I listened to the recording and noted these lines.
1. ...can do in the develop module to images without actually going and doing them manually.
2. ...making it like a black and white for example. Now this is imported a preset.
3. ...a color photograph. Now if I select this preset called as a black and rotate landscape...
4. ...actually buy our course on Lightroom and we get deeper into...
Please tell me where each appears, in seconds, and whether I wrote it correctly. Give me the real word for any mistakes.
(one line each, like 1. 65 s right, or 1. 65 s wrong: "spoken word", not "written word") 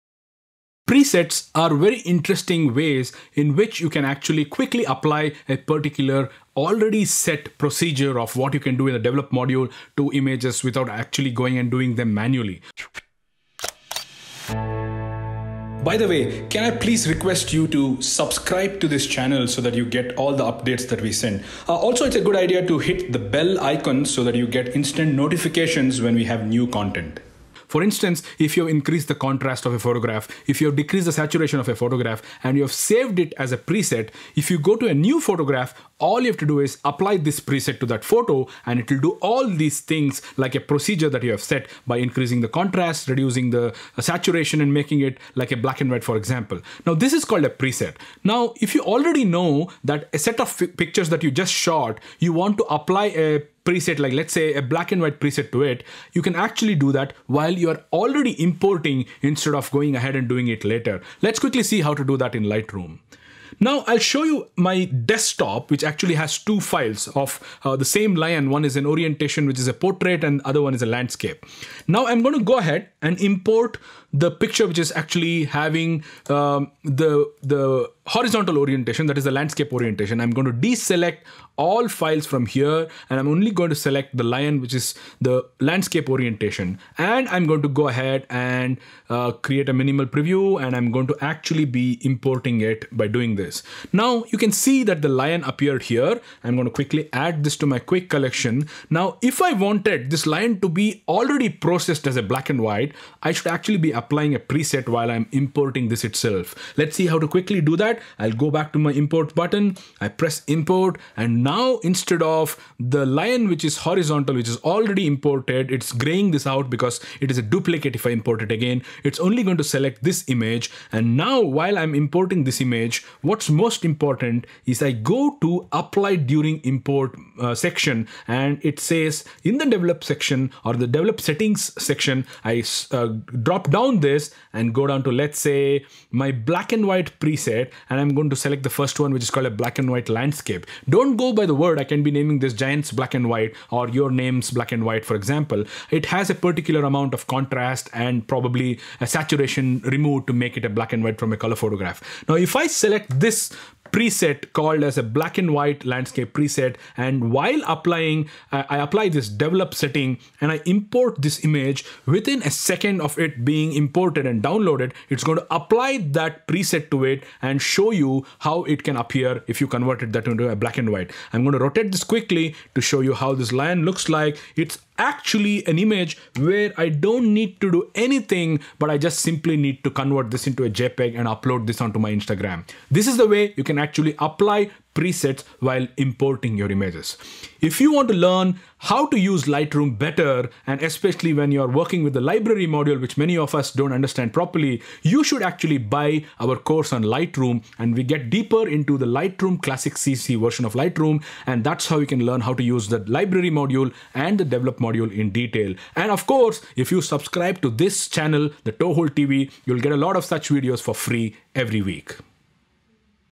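1. 8 s right
2. 44 s wrong: "called", not "imported"
3. 151 s wrong: "white", not "rotate"
4. 195 s right.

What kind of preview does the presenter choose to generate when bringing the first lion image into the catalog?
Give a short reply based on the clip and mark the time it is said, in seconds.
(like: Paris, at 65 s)
Minimal preview, at 89 s.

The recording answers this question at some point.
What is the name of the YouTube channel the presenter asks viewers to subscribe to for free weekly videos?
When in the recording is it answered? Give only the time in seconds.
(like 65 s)
208 s.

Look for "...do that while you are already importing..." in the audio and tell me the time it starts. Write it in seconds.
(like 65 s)
56 s.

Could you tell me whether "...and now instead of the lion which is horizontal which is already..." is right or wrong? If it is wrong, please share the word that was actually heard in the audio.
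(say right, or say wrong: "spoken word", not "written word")
right.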